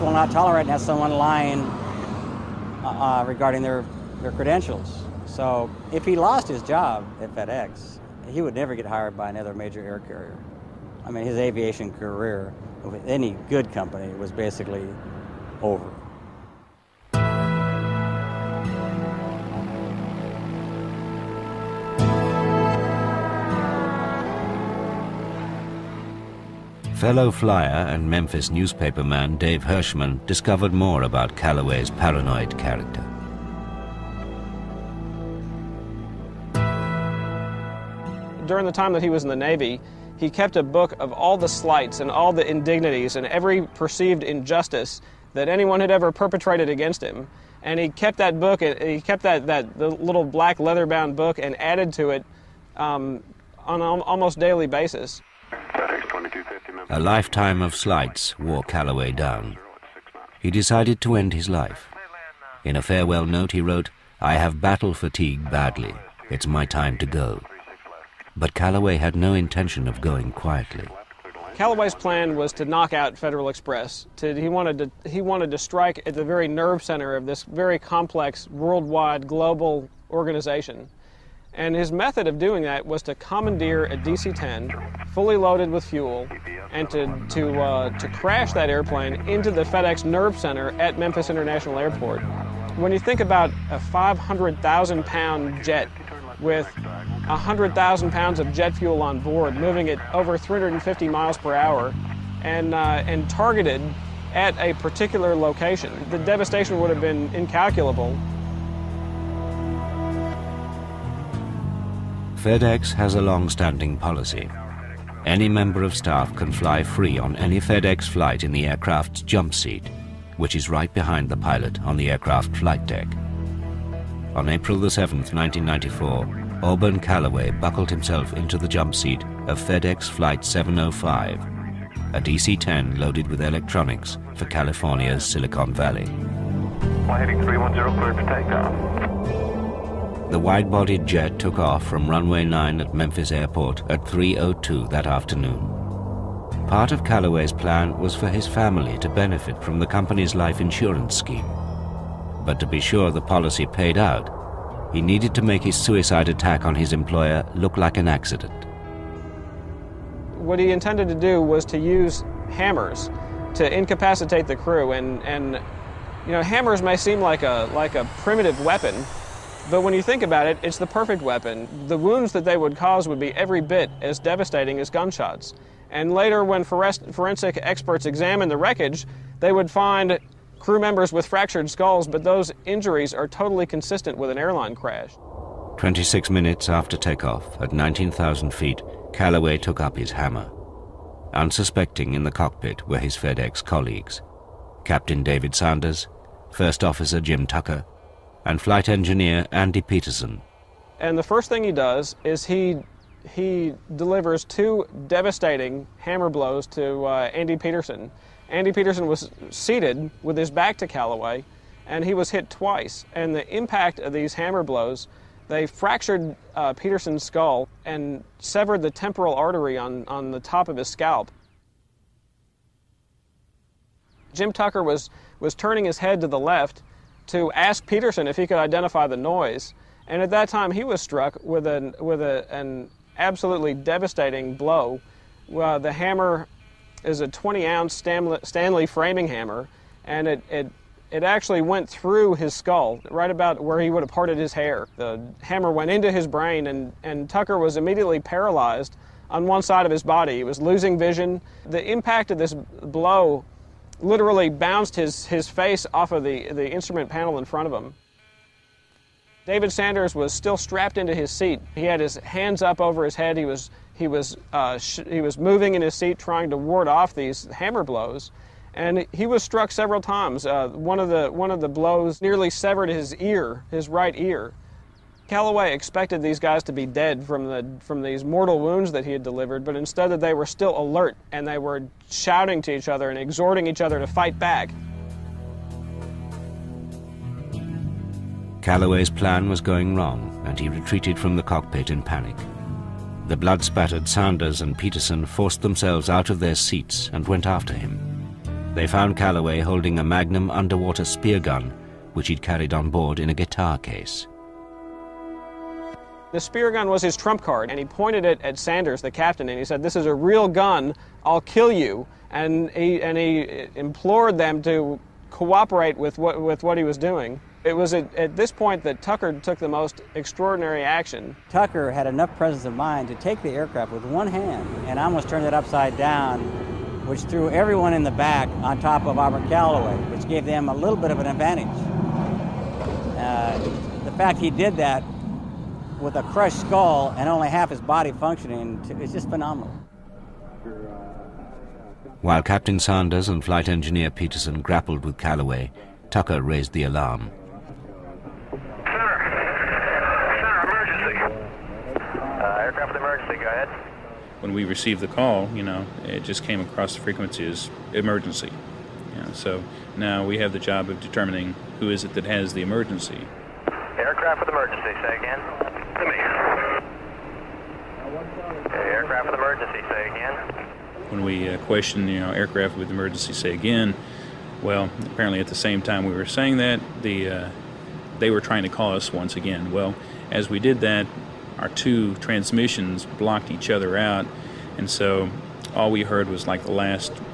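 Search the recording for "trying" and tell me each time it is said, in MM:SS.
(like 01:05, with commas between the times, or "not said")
04:26, 06:18.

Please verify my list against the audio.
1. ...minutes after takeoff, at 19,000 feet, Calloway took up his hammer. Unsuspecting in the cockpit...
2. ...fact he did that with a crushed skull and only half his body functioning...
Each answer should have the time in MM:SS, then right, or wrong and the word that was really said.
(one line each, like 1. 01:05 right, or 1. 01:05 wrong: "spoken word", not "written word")
1. 03:06 right
2. 05:34 right.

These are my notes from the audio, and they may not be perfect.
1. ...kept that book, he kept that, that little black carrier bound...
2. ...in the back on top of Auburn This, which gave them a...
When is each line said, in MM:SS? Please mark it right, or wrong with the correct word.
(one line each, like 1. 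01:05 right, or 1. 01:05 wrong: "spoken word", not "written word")
1. 00:47 wrong: "leather", not "carrier"
2. 05:27 wrong: "Calloway", not "This".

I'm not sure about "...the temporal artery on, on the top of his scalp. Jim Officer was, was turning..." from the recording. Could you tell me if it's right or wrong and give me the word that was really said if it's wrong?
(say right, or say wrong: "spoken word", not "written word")
wrong: "Tucker", not "Officer".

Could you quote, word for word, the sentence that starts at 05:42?
While Captain Sanders and Flight Engineer Peterson grappled with Calloway, Tucker raised the alarm.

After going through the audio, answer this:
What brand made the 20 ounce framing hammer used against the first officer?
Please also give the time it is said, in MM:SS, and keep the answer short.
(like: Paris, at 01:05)
Stanley, at 03:57.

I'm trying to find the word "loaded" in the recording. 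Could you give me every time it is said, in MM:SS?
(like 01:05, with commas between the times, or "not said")
01:25, 02:12.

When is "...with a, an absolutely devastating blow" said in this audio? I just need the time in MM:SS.
03:51.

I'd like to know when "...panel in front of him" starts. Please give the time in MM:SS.
04:17.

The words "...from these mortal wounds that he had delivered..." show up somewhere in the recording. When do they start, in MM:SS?
04:37.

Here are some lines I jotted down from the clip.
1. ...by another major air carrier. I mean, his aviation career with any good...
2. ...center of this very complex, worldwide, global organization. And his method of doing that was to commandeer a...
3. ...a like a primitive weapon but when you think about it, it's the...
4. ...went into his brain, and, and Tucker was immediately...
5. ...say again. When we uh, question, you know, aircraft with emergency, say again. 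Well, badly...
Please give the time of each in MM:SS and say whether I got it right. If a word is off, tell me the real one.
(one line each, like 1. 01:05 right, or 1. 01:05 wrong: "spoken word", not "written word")
1. 00:09 right
2. 01:16 right
3. 02:47 right
4. 04:05 right
5. 06:09 wrong: "apparently", not "badly".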